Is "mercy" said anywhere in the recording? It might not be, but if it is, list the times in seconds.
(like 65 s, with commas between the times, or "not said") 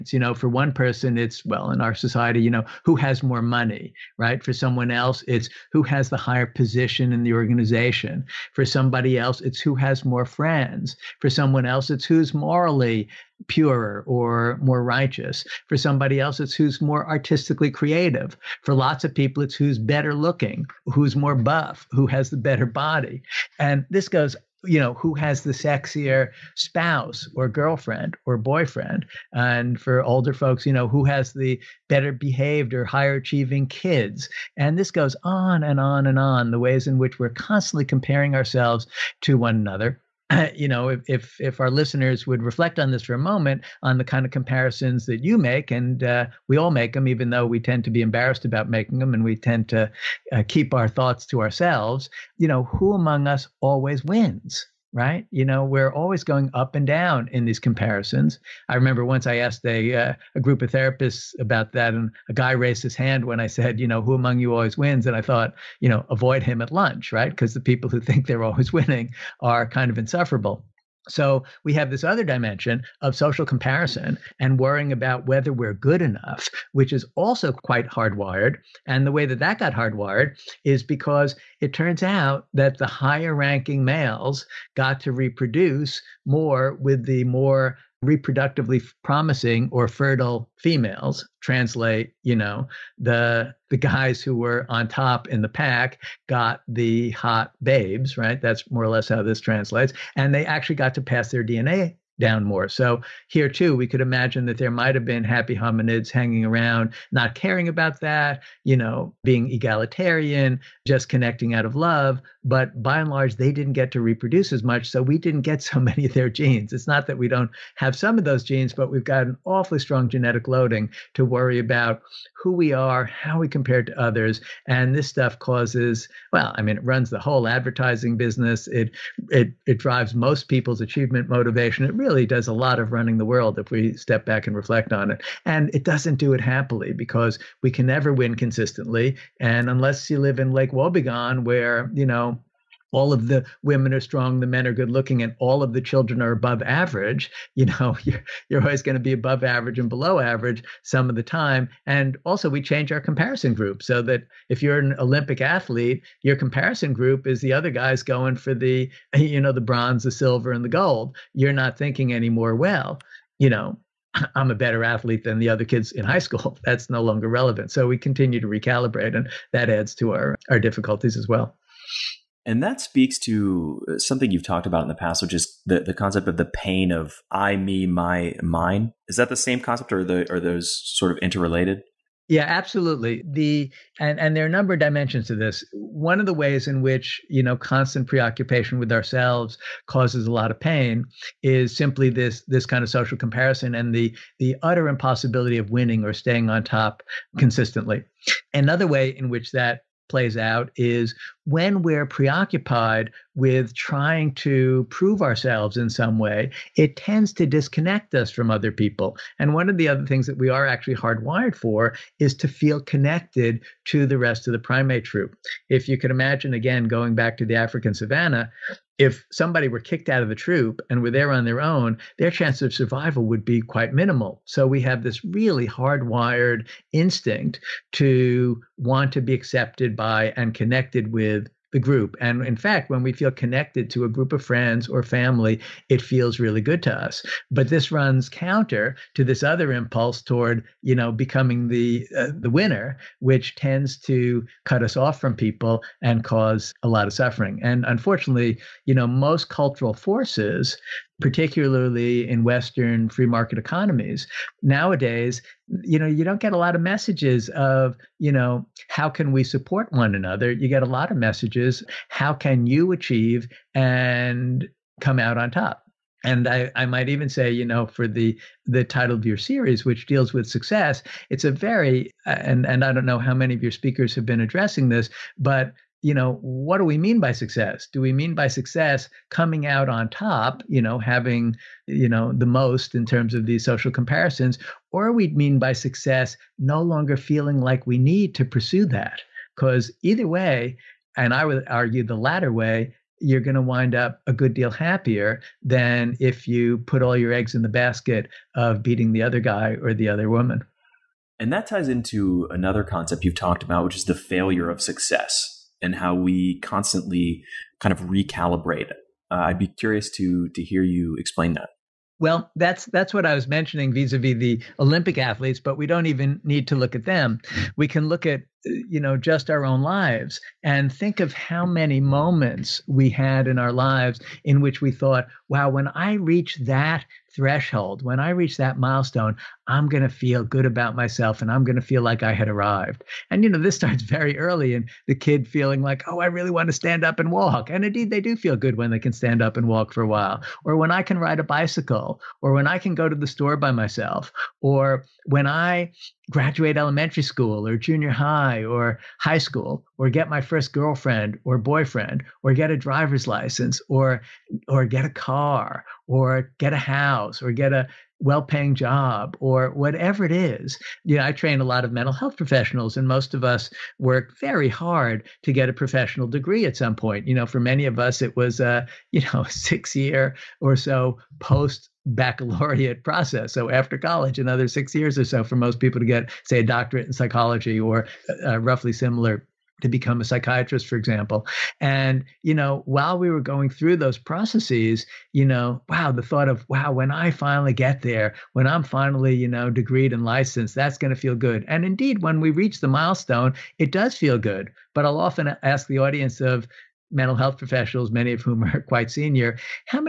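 not said.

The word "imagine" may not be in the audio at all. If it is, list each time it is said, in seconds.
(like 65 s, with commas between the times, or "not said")
104 s, 216 s.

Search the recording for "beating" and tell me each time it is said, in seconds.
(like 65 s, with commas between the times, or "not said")
298 s.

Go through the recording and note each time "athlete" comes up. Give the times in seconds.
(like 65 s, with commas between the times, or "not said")
155 s, 164 s, 315 s.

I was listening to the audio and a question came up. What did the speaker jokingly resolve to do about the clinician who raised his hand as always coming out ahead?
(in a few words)
Avoid him at lunch.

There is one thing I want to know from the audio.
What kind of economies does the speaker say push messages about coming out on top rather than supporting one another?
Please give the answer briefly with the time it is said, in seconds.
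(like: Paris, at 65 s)
Western free market economies, at 252 s.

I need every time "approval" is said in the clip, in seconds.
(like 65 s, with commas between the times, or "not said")
not said.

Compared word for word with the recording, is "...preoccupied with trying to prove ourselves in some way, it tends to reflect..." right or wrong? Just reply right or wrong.
wrong.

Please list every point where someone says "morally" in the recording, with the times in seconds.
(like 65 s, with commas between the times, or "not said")
12 s.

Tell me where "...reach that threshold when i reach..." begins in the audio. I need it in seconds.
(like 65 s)
326 s.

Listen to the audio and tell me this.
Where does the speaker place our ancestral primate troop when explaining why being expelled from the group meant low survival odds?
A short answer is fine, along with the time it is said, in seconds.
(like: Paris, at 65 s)
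African savannah, at 217 s.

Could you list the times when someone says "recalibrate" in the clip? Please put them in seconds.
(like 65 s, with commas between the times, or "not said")
168 s, 308 s.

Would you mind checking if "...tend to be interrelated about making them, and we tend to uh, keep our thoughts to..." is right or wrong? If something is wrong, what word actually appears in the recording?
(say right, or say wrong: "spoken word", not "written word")
wrong: "embarrassed", not "interrelated".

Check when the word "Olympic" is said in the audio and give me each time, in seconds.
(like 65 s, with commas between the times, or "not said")
154 s, 314 s.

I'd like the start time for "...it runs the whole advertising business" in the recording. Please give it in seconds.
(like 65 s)
126 s.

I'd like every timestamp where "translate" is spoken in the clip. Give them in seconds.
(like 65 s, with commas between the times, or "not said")
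91 s, 99 s.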